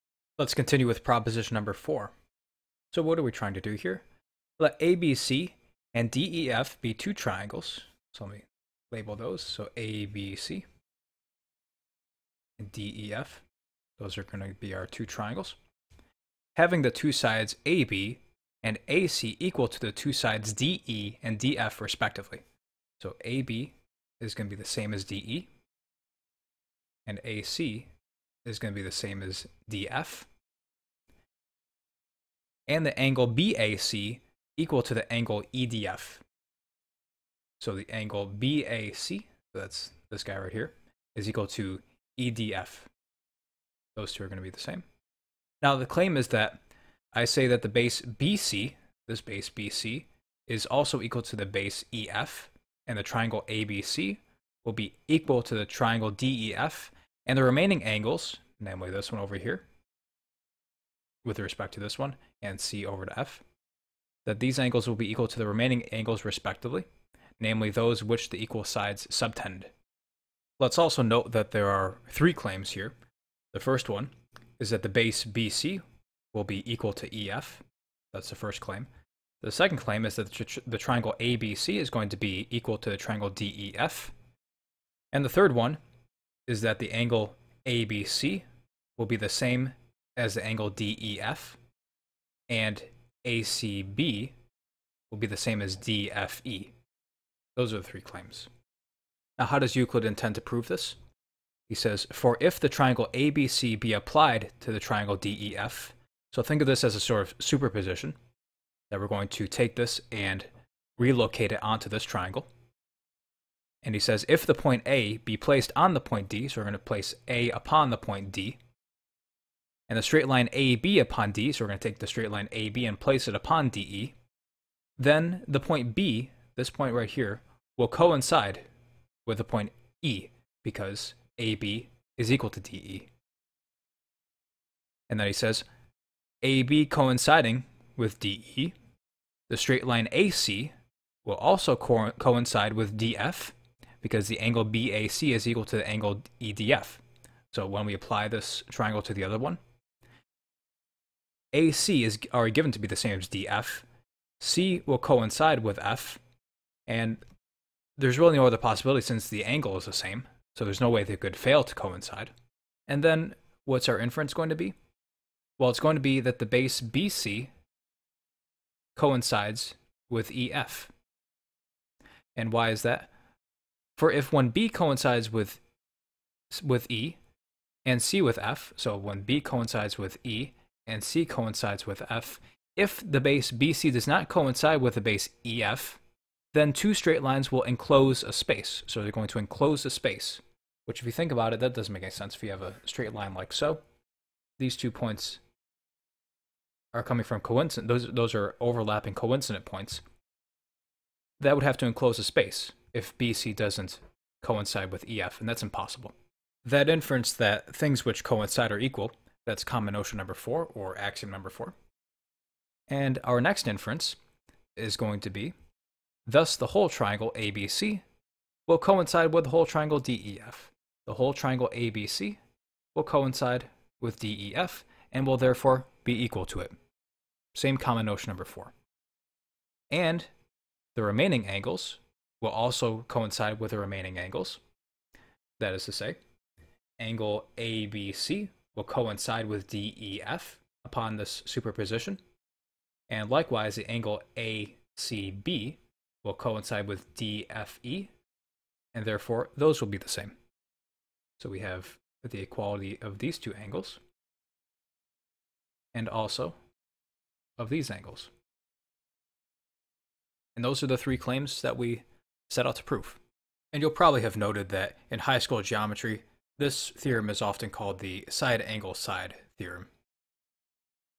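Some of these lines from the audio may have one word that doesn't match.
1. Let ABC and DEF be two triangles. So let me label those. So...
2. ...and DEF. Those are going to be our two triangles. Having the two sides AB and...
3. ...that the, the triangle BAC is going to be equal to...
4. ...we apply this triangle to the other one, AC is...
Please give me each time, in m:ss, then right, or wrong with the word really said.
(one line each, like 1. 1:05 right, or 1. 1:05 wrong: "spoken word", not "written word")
1. 0:04 right
2. 0:12 right
3. 1:20 wrong: "ABC", not "BAC"
4. 2:27 right.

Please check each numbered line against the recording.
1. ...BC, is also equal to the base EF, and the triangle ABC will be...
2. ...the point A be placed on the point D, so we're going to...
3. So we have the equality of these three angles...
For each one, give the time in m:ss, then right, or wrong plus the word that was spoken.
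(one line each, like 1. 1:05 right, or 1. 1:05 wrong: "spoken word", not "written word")
1. 0:49 right
2. 1:54 right
3. 4:11 wrong: "two", not "three".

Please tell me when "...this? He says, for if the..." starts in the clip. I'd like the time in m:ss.
1:40.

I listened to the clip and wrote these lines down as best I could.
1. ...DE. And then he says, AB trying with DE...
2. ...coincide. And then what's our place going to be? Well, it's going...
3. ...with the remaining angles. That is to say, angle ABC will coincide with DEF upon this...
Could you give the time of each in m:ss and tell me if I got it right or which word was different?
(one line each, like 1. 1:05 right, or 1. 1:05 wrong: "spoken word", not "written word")
1. 2:12 wrong: "coinciding", not "trying"
2. 2:41 wrong: "inference", not "place"
3. 3:53 right.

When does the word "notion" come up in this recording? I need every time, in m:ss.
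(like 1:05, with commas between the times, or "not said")
3:29, 3:48.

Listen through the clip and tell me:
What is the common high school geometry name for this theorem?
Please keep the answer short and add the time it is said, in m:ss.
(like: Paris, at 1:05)
Side angle side theorem, at 4:28.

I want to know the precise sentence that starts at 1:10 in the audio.
Let's also note that there are three claims here.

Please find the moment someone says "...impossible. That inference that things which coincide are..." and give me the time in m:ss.
3:25.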